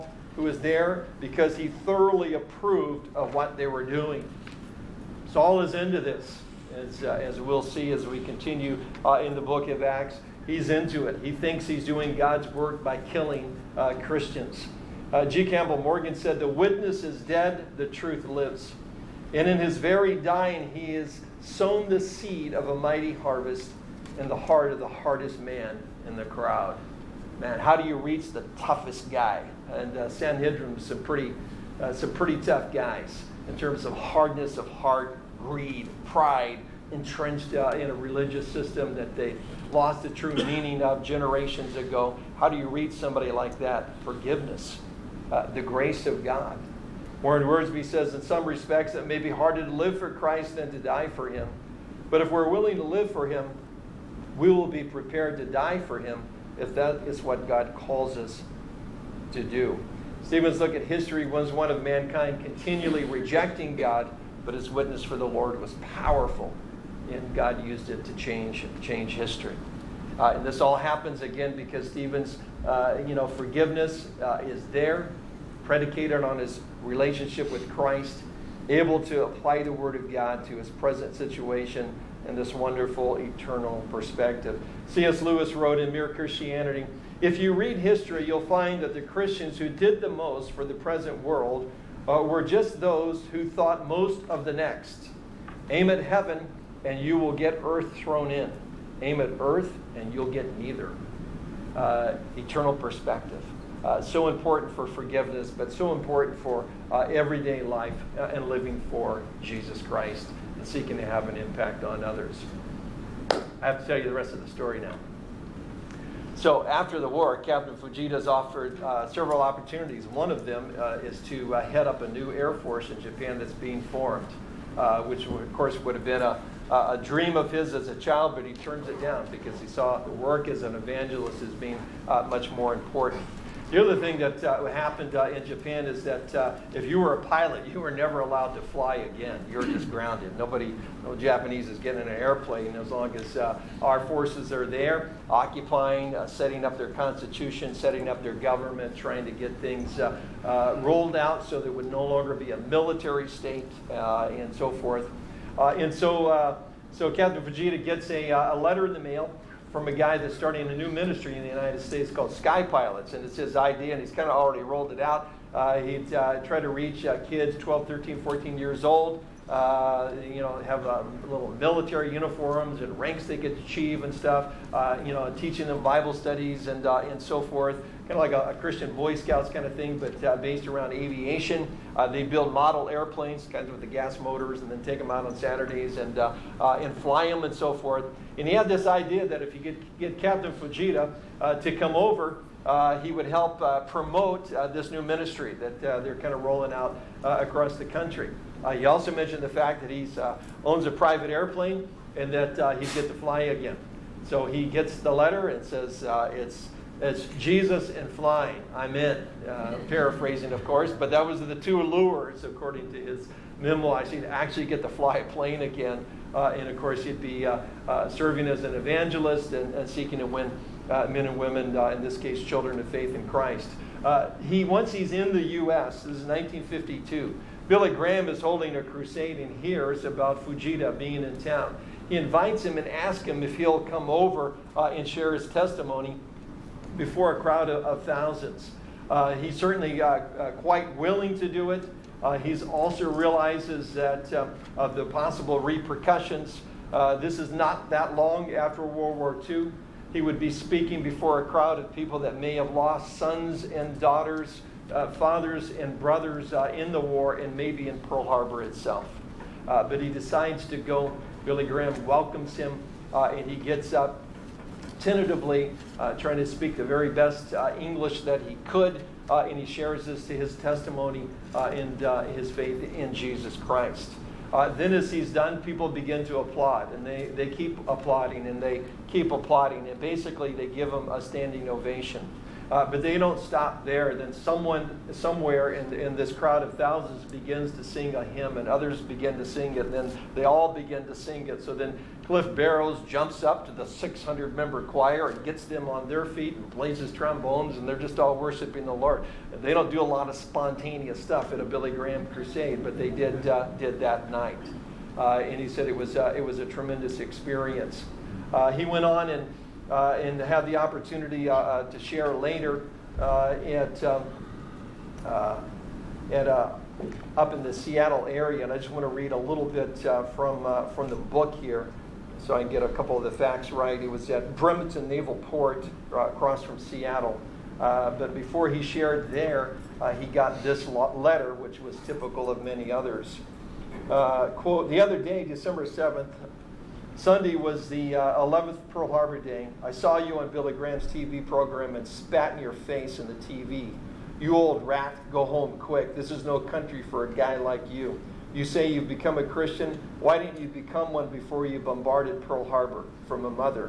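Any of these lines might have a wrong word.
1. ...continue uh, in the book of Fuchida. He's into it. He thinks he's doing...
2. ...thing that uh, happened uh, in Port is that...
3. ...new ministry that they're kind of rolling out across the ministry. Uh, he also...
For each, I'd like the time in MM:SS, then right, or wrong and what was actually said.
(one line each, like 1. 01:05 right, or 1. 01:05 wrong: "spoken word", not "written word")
1. 00:08 wrong: "Acts", not "Fuchida"
2. 02:14 wrong: "Japan", not "Port"
3. 03:14 wrong: "country", not "ministry".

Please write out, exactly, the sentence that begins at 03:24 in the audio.
So he gets the letter and says, it's, it's Jesus and flying.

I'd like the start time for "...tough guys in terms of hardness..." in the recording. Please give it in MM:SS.
00:32.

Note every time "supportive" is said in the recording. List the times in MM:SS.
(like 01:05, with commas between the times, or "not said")
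not said.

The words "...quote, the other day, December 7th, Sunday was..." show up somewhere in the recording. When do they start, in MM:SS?
05:34.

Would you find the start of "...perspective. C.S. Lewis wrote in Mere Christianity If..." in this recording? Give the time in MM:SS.
01:23.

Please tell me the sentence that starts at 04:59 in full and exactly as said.
they don't do a lot of spontaneous stuff at a Billy Graham crusade, but they did, uh, did that night.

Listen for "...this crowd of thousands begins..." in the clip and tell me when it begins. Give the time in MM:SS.
04:46.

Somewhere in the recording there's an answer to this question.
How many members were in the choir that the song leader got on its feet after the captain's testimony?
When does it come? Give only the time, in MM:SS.
04:53.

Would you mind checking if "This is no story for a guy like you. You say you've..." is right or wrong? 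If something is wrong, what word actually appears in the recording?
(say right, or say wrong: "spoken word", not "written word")
wrong: "country", not "story".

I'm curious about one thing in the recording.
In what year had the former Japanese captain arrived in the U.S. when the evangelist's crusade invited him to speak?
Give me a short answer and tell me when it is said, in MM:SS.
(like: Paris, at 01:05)
1952, at 03:46.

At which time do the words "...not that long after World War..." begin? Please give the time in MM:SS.
04:07.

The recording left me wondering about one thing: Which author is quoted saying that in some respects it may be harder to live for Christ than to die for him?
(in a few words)
Warren Wiersbe.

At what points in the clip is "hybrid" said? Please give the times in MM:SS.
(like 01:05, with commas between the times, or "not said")
not said.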